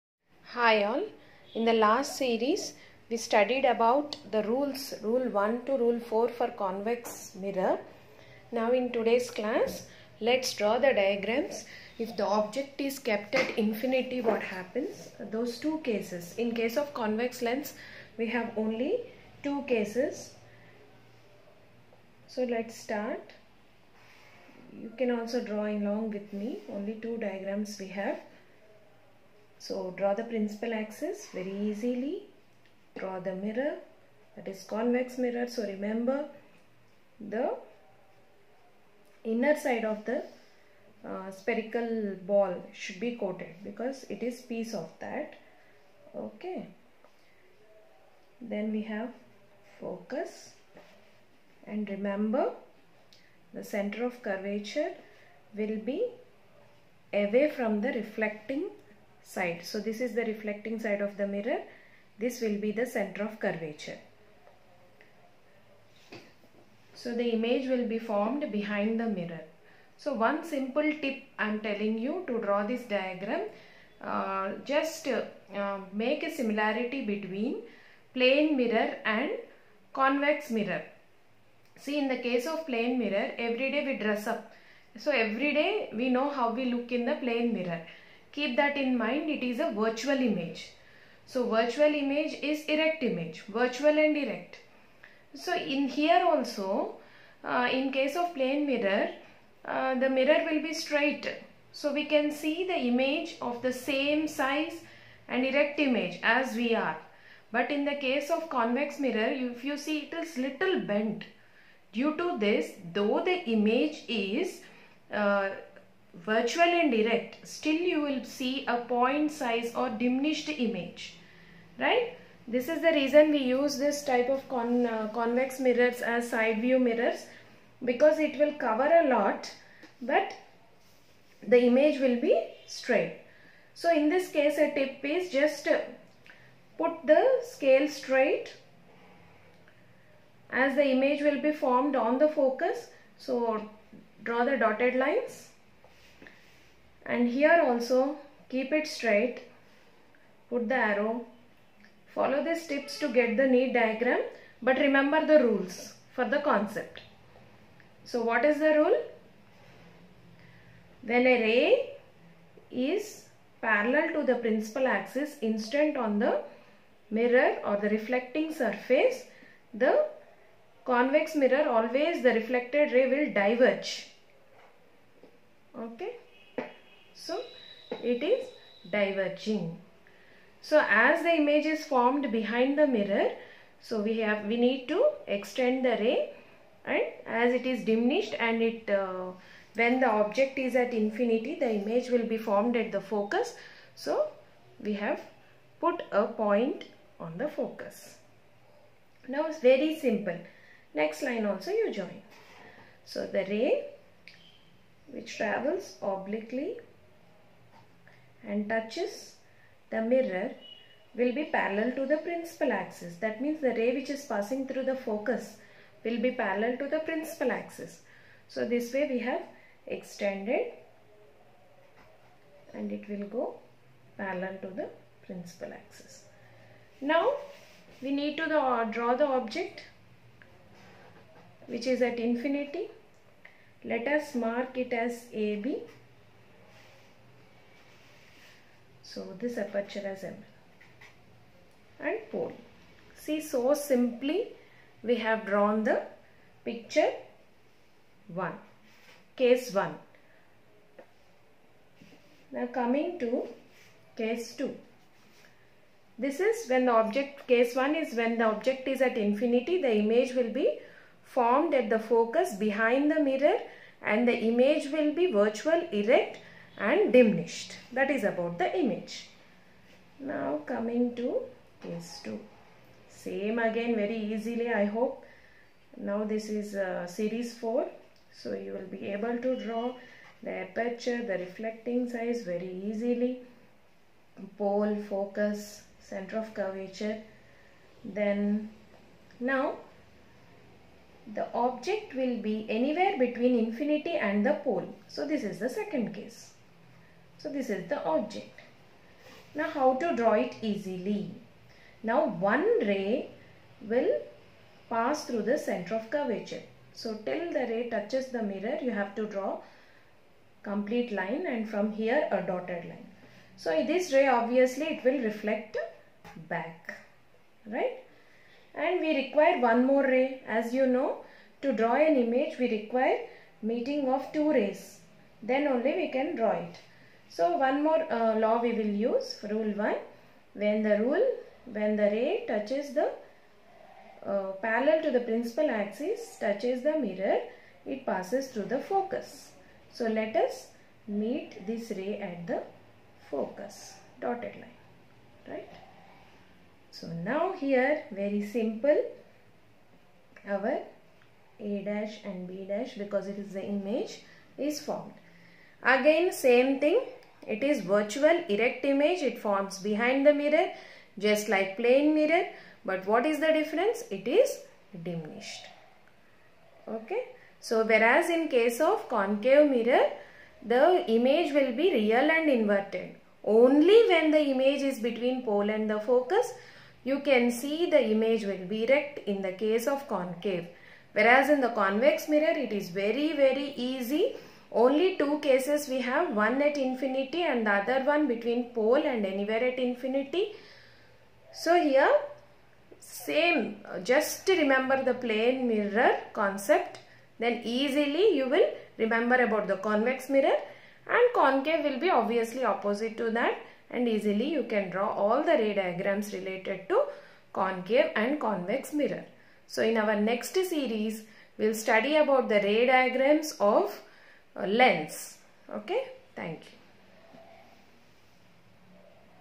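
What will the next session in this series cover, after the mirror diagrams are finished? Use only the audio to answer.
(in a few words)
Ray diagrams of lens.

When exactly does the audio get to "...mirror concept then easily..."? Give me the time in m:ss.
6:35.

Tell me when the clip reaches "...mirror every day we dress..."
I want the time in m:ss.
1:22.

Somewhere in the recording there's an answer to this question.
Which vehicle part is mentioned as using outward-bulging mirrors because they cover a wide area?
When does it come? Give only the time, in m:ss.
2:06.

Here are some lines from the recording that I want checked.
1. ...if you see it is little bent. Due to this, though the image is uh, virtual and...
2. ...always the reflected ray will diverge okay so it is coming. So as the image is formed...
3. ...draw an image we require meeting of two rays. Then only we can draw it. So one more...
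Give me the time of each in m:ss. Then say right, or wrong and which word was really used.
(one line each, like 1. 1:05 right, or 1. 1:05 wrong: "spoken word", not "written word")
1. 1:49 right
2. 2:51 wrong: "diverging", not "coming"
3. 5:21 right.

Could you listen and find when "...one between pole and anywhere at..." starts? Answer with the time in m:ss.
6:28.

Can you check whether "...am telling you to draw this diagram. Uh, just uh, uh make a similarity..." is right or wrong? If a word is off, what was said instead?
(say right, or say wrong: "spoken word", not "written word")
right.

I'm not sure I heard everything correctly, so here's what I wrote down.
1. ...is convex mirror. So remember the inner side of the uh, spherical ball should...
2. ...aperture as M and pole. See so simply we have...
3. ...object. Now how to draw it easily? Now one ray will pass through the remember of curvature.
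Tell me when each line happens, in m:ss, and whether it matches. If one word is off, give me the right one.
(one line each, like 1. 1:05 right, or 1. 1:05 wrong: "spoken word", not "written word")
1. 0:34 right
2. 3:59 right
3. 4:58 wrong: "center", not "remember".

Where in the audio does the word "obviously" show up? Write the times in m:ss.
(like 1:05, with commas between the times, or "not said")
5:14, 6:42.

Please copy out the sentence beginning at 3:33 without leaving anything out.
That means the ray which is passing through the focus will be parallel to the principal axis.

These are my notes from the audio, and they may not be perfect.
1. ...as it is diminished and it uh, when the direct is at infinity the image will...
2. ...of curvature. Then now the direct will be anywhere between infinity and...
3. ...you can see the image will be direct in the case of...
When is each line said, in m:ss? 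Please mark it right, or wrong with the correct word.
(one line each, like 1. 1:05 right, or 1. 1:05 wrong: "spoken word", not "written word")
1. 3:07 wrong: "object", not "direct"
2. 4:46 wrong: "object", not "direct"
3. 6:17 wrong: "erect", not "direct".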